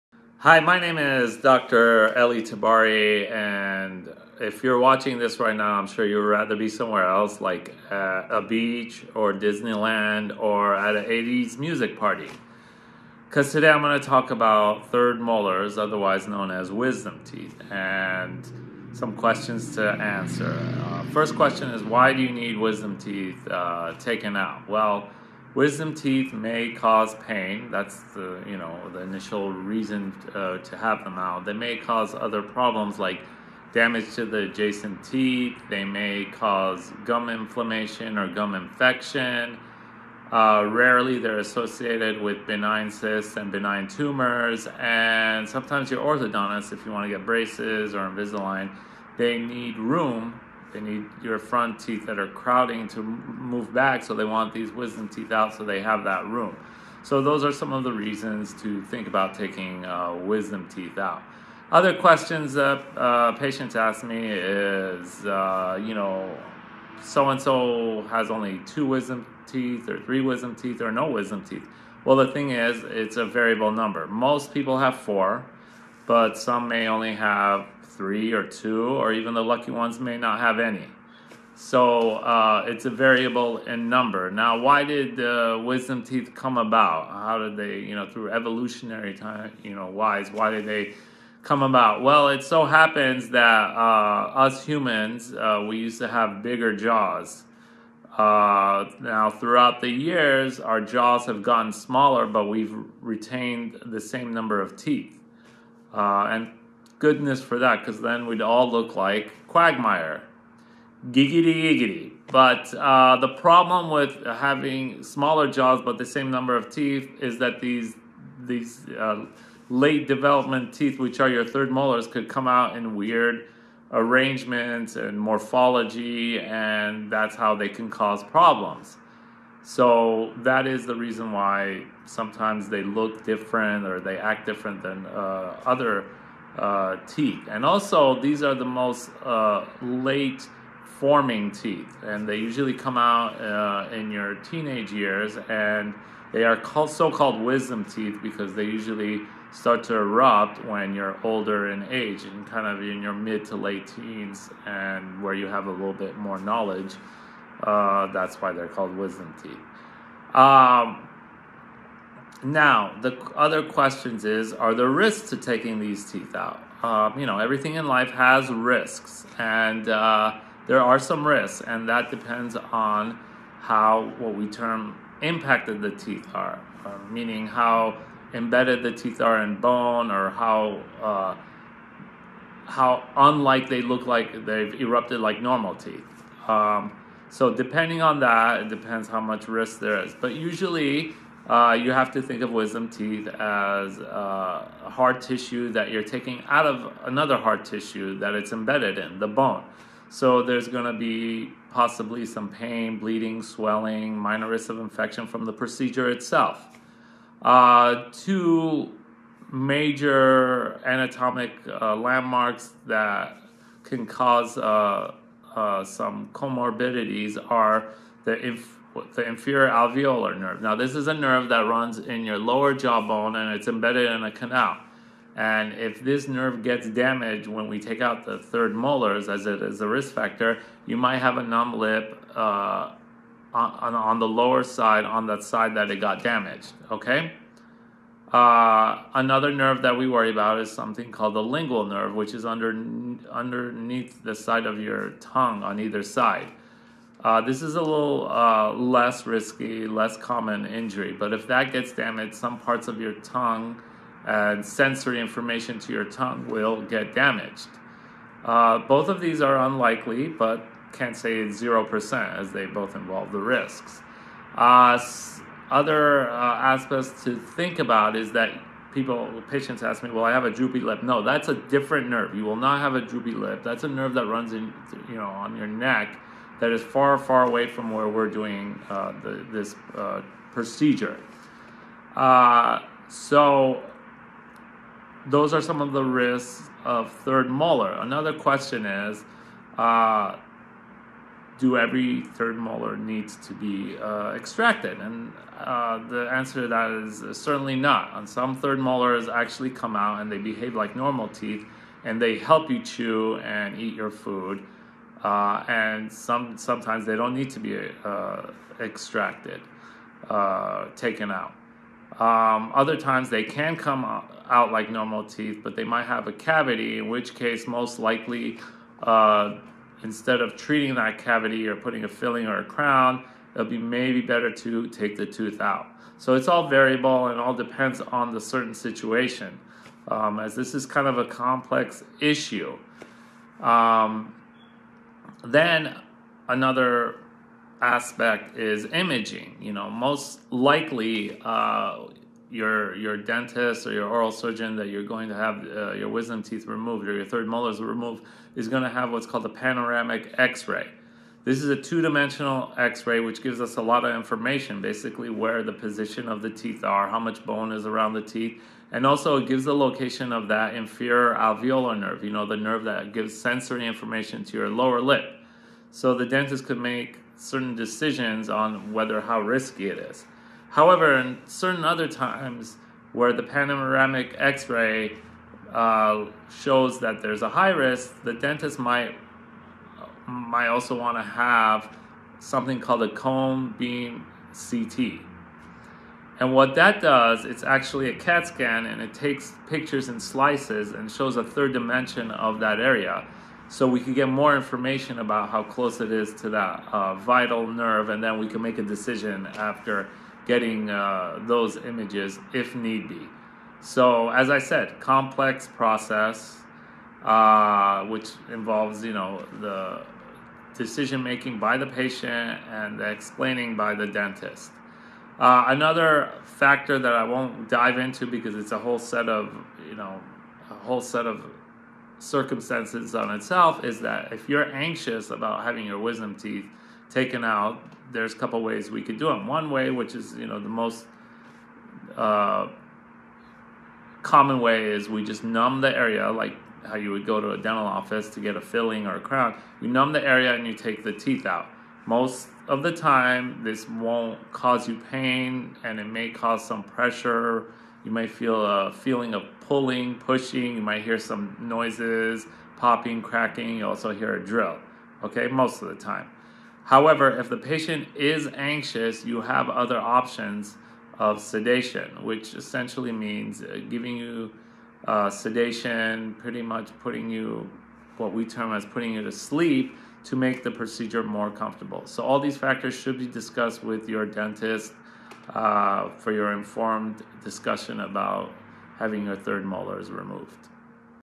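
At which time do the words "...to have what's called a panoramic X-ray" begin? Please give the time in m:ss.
5:48.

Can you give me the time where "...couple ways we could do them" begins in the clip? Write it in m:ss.
7:08.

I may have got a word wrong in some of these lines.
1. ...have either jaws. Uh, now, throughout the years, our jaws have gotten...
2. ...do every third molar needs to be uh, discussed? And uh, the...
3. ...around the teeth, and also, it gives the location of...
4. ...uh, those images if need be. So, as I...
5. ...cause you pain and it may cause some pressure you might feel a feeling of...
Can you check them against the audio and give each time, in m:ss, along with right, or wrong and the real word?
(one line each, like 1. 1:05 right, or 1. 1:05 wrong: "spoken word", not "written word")
1. 1:36 wrong: "bigger", not "either"
2. 4:51 wrong: "extracted", not "discussed"
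3. 5:57 right
4. 6:40 right
5. 7:24 right.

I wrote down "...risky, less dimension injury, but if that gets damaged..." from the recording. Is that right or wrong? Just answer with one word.
wrong.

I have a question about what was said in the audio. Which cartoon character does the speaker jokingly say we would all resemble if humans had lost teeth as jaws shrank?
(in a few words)
Quagmire.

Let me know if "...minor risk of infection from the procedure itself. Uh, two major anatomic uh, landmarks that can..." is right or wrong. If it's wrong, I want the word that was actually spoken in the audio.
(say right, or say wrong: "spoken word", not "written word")
right.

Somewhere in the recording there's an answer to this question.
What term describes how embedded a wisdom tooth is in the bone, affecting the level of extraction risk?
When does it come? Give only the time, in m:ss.
2:55.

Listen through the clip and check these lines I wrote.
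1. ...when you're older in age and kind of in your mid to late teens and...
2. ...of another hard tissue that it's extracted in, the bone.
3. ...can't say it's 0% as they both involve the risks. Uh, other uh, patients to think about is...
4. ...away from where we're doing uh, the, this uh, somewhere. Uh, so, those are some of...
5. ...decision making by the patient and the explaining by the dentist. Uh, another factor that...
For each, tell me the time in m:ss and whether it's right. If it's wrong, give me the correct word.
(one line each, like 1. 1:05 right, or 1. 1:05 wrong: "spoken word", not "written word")
1. 2:30 right
2. 3:16 wrong: "embedded", not "extracted"
3. 4:20 wrong: "aspects", not "patients"
4. 4:37 wrong: "procedure", not "somewhere"
5. 6:50 right.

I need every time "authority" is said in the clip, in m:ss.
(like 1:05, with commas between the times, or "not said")
not said.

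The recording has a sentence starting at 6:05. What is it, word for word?
So the dentist could make certain decisions on whether how risky it is.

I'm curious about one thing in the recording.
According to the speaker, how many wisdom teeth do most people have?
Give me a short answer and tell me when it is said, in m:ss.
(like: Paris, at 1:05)
4, at 1:14.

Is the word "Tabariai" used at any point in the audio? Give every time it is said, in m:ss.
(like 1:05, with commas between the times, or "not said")
0:02.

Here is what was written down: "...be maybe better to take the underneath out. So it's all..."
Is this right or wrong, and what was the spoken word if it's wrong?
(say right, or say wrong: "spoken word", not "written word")
wrong: "tooth", not "underneath".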